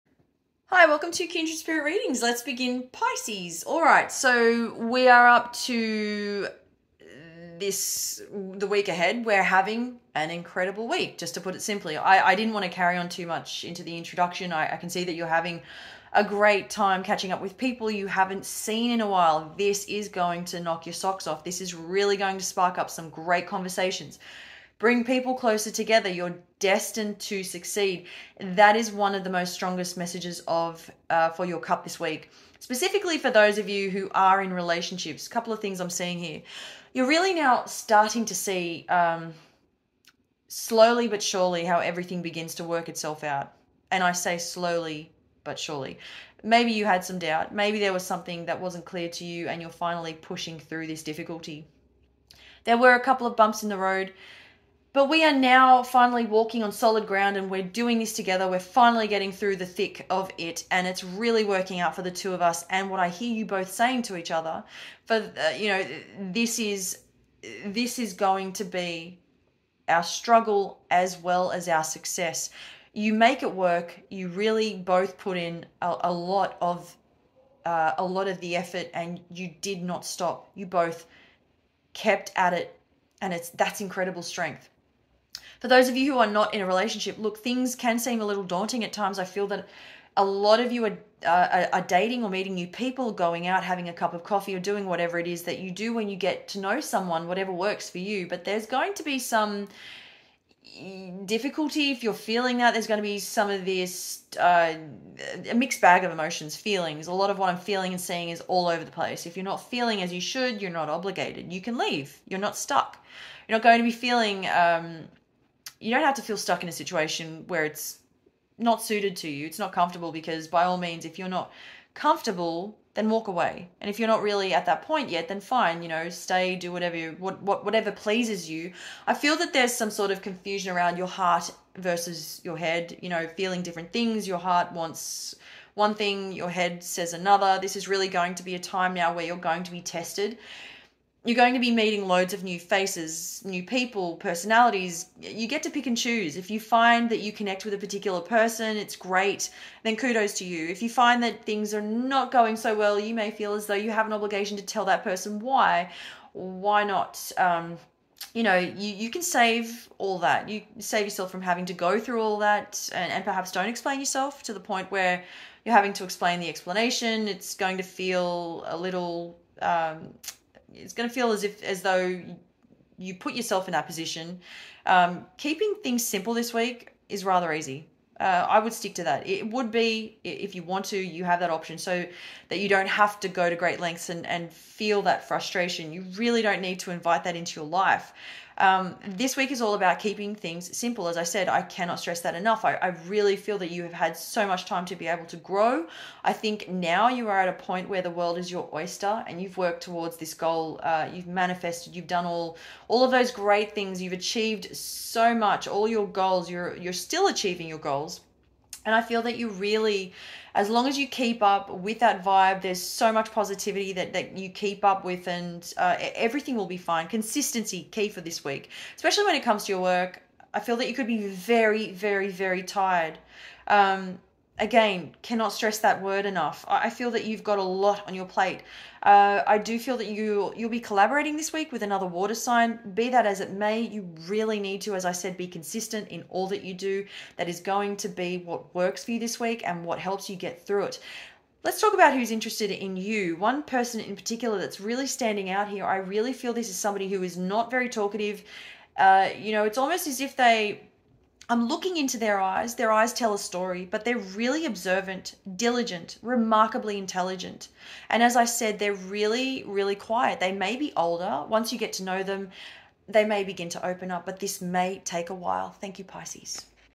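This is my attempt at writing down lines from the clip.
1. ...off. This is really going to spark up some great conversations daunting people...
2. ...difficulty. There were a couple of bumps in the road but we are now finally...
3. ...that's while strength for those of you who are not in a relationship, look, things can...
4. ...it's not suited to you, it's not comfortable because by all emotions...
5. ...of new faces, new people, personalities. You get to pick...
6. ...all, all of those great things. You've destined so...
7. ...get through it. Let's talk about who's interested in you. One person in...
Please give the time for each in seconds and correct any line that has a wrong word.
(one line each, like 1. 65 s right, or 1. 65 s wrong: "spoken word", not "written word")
1. 21 s wrong: "bring", not "daunting"
2. 51 s right
3. 83 s wrong: "incredible", not "while"
4. 117 s wrong: "means", not "emotions"
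5. 142 s right
6. 202 s wrong: "achieved", not "destined"
7. 240 s right.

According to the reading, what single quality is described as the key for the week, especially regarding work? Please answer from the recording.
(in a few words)
Consistency.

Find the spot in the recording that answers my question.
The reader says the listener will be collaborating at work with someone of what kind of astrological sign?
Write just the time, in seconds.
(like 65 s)
232 s.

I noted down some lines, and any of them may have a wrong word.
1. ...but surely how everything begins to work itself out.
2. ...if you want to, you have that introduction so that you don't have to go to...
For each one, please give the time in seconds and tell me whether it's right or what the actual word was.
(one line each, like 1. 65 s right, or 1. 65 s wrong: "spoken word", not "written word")
1. 41 s right
2. 180 s wrong: "option", not "introduction".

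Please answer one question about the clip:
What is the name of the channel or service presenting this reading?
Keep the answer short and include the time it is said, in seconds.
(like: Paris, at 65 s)
Kindred Spirit Readings, at 1 s.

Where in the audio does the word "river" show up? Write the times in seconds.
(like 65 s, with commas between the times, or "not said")
not said.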